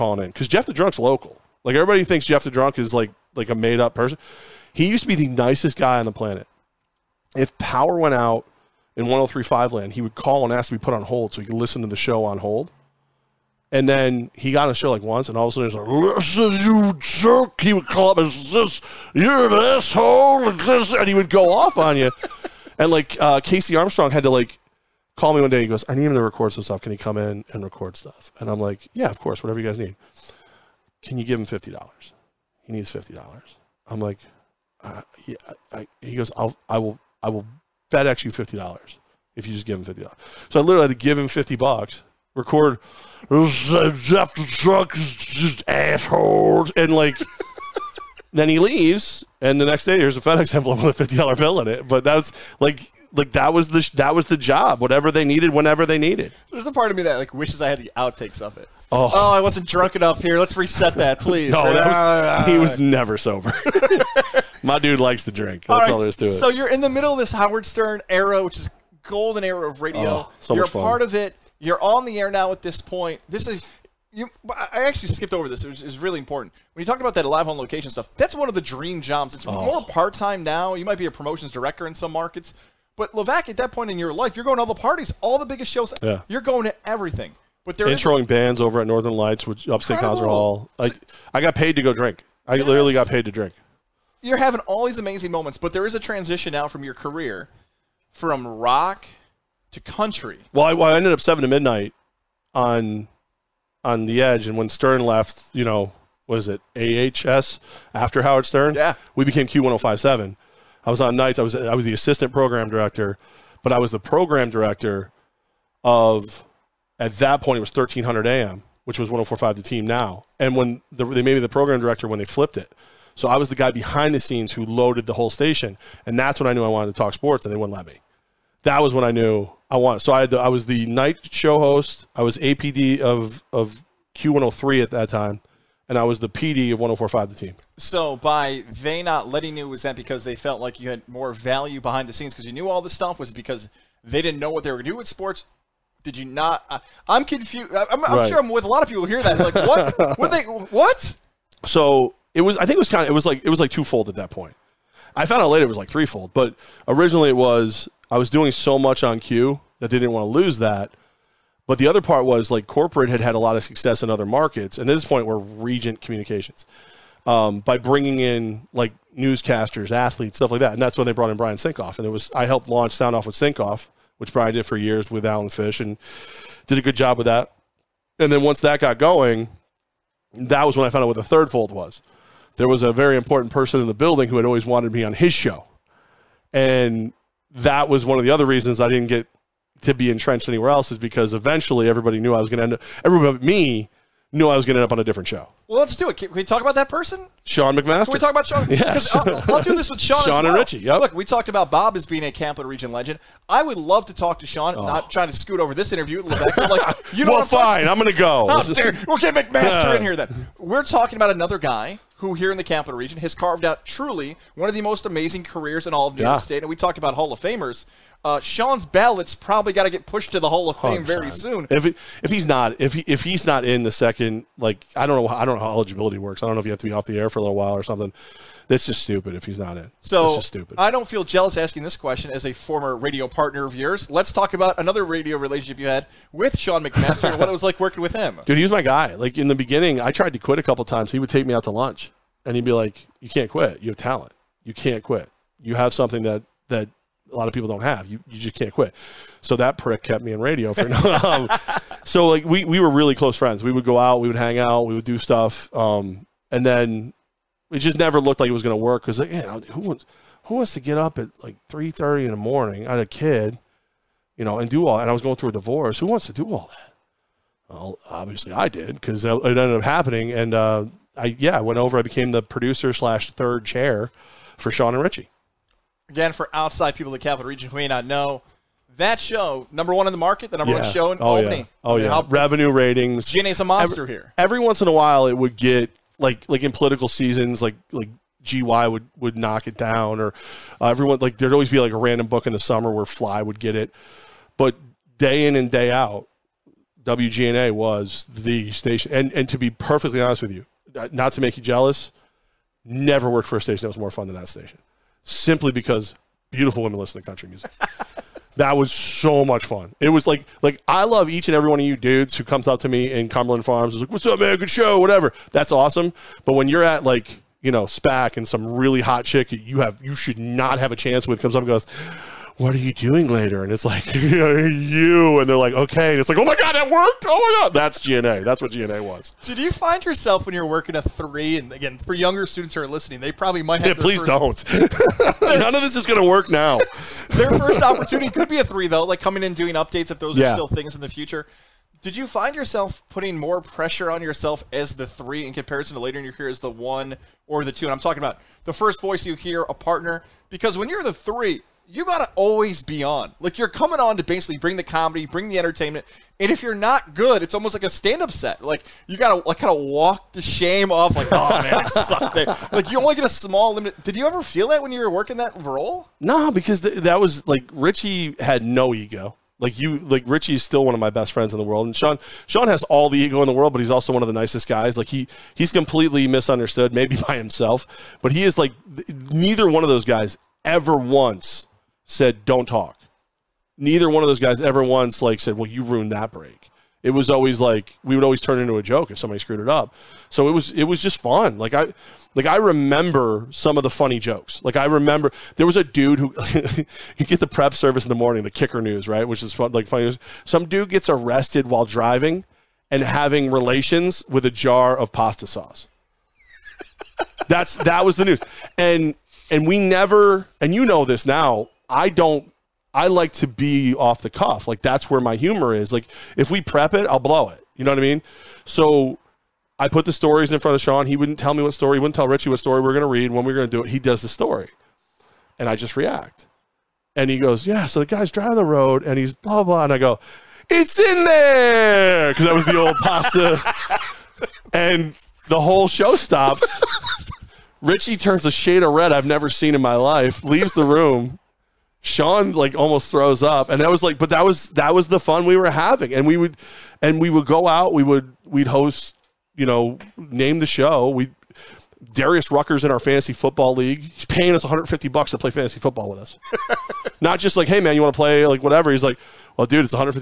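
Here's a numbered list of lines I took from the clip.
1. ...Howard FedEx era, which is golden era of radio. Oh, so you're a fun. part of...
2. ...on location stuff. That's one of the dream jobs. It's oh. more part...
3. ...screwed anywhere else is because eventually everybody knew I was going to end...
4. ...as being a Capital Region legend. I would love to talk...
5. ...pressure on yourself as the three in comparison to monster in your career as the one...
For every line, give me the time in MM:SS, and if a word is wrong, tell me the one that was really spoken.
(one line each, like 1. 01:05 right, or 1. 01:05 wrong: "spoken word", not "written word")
1. 01:07 wrong: "Stern", not "FedEx"
2. 01:17 right
3. 03:10 wrong: "entrenched", not "screwed"
4. 03:21 right
5. 05:43 wrong: "later", not "monster".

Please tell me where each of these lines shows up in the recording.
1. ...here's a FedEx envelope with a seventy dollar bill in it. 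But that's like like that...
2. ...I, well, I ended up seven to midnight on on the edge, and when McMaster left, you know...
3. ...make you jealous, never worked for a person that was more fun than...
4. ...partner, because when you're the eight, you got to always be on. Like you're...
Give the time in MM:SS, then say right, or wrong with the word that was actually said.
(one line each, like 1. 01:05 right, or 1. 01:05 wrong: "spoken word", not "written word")
1. 00:49 wrong: "fifty", not "seventy"
2. 01:40 wrong: "Stern", not "McMaster"
3. 05:01 wrong: "station", not "person"
4. 05:49 wrong: "three", not "eight".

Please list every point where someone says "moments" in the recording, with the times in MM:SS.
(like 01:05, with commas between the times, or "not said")
01:35.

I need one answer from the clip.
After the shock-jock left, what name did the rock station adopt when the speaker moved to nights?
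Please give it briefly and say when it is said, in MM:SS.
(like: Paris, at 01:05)
Q1057, at 01:49.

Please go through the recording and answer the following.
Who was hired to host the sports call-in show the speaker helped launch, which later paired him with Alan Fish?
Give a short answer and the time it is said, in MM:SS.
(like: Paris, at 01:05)
Brian Sinkoff, at 02:51.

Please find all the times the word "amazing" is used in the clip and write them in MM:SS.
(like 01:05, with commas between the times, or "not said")
01:34, 03:35.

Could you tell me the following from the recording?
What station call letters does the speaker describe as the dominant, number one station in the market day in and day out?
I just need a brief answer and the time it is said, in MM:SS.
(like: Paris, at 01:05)
WGNA, at 04:57.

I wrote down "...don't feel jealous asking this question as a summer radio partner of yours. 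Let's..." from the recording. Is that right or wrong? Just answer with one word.
wrong.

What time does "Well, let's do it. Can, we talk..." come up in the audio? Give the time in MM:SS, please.
03:15.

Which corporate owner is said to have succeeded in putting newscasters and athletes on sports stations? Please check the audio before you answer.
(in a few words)
Regent Communications.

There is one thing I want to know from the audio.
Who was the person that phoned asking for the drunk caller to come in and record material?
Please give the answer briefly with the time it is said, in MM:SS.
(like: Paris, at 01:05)
Casey Armstrong, at 00:23.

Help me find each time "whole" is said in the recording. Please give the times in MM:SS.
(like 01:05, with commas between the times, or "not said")
02:05, 07:15.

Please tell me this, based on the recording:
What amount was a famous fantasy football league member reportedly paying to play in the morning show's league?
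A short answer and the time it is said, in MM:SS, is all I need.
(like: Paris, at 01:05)
$150, at 07:34.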